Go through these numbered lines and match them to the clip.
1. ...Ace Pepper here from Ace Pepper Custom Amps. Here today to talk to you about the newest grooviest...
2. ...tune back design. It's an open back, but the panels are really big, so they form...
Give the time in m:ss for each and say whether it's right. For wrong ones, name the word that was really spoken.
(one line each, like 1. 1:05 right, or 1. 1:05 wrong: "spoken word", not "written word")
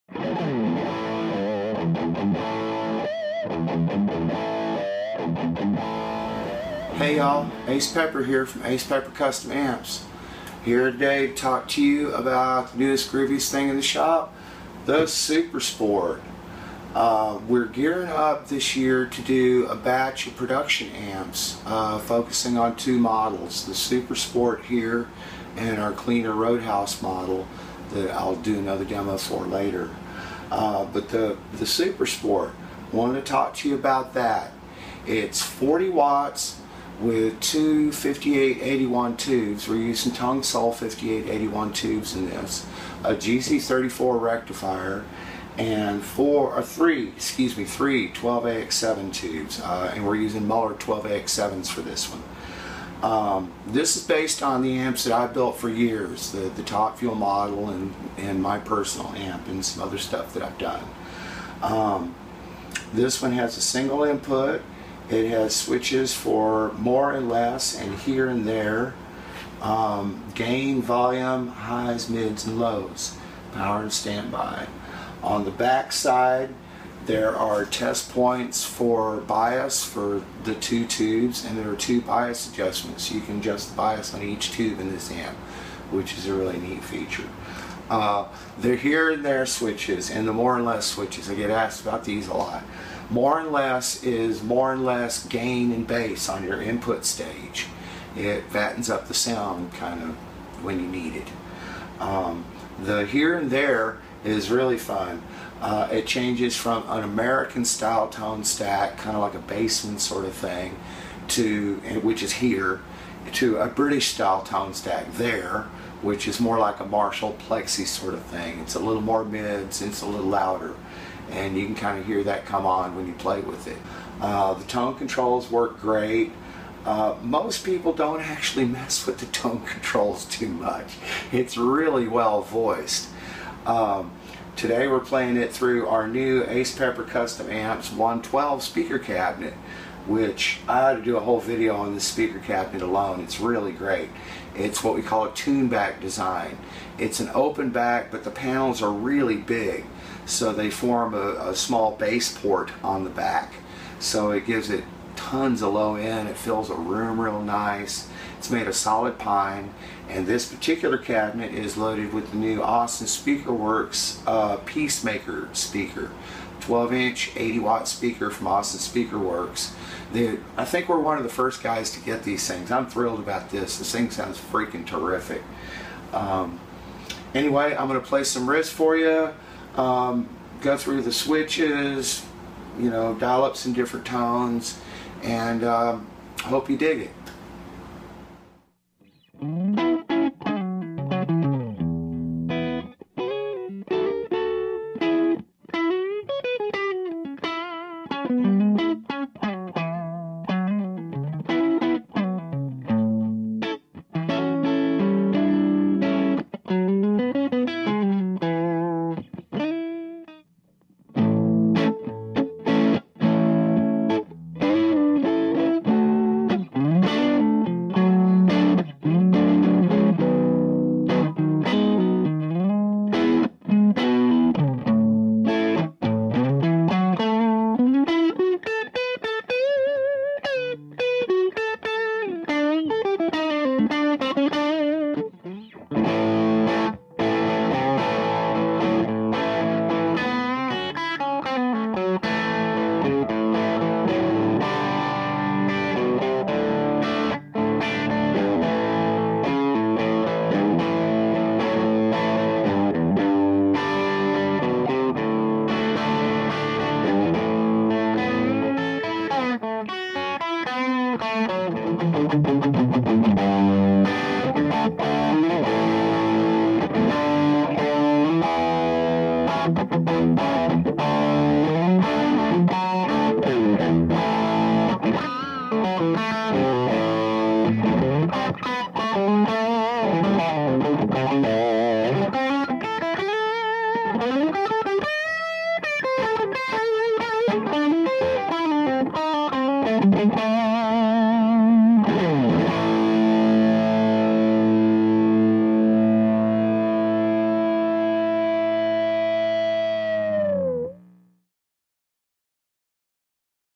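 1. 0:07 right
2. 2:25 right.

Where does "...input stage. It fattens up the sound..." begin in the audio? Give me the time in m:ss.
1:36.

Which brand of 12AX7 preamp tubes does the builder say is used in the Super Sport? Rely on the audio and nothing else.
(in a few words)
Mullard.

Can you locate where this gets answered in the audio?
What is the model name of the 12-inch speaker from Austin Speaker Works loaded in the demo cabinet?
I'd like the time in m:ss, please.
2:44.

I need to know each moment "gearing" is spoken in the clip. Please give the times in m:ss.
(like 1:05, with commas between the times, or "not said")
0:17.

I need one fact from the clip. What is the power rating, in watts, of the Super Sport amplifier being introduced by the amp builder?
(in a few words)
40 watts.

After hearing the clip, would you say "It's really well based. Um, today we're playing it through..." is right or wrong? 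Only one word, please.
wrong.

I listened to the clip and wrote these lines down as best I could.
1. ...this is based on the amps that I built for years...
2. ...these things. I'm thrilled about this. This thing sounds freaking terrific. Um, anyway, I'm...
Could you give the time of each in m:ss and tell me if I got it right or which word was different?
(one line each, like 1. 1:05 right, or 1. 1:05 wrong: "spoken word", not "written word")
1. 0:53 right
2. 2:52 right.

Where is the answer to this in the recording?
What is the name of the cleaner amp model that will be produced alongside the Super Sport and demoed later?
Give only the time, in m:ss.
0:26.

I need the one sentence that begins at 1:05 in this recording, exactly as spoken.
It has switches for more and less and here and there.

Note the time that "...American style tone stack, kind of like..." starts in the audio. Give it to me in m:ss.
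1:47.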